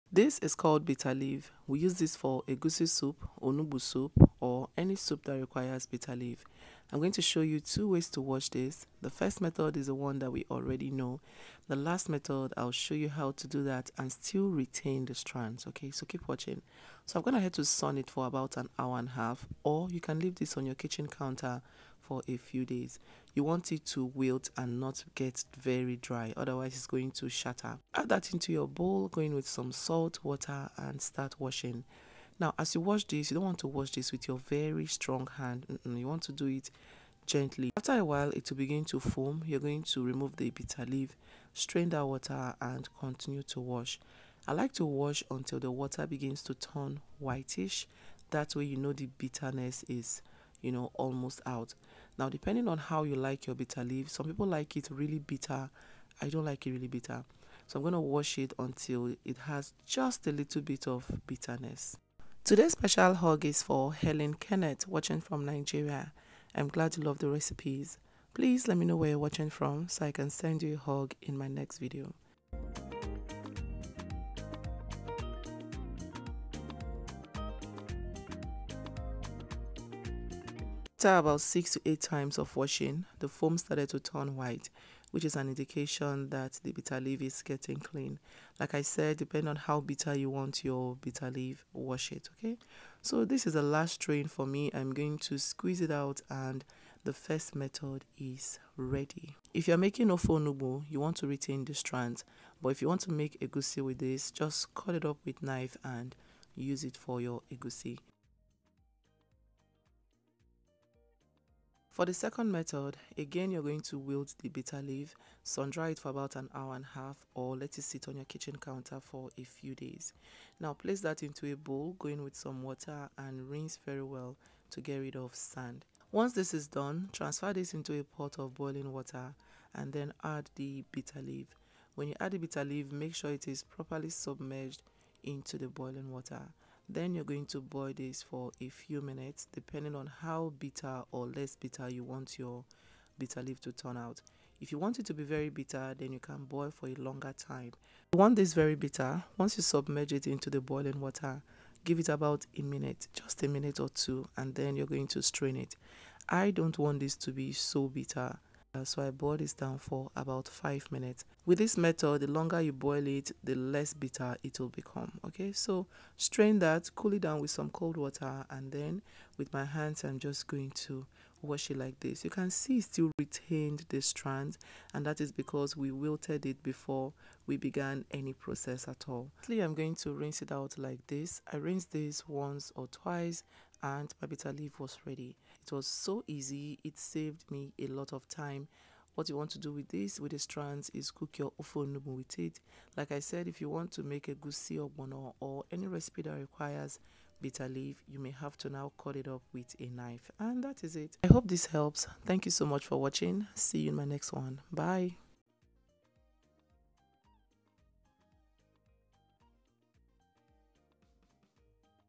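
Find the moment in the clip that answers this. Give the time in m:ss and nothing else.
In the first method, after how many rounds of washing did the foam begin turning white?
1:21.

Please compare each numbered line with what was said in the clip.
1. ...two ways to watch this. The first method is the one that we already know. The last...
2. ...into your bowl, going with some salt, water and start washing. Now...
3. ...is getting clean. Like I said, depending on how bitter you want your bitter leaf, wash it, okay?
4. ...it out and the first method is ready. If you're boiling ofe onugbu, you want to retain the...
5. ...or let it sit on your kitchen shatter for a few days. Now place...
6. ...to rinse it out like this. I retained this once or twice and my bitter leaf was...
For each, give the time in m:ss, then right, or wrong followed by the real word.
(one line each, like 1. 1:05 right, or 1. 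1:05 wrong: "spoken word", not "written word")
1. 0:07 right
2. 0:28 right
3. 1:27 right
4. 1:35 wrong: "making", not "boiling"
5. 1:57 wrong: "counter", not "shatter"
6. 2:59 wrong: "rinsed", not "retained".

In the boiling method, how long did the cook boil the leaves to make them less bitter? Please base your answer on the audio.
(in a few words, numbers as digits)
5 minutes.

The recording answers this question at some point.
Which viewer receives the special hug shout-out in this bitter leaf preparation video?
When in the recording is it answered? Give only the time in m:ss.
1:03.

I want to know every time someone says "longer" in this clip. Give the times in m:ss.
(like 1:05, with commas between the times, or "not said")
2:26, 2:42.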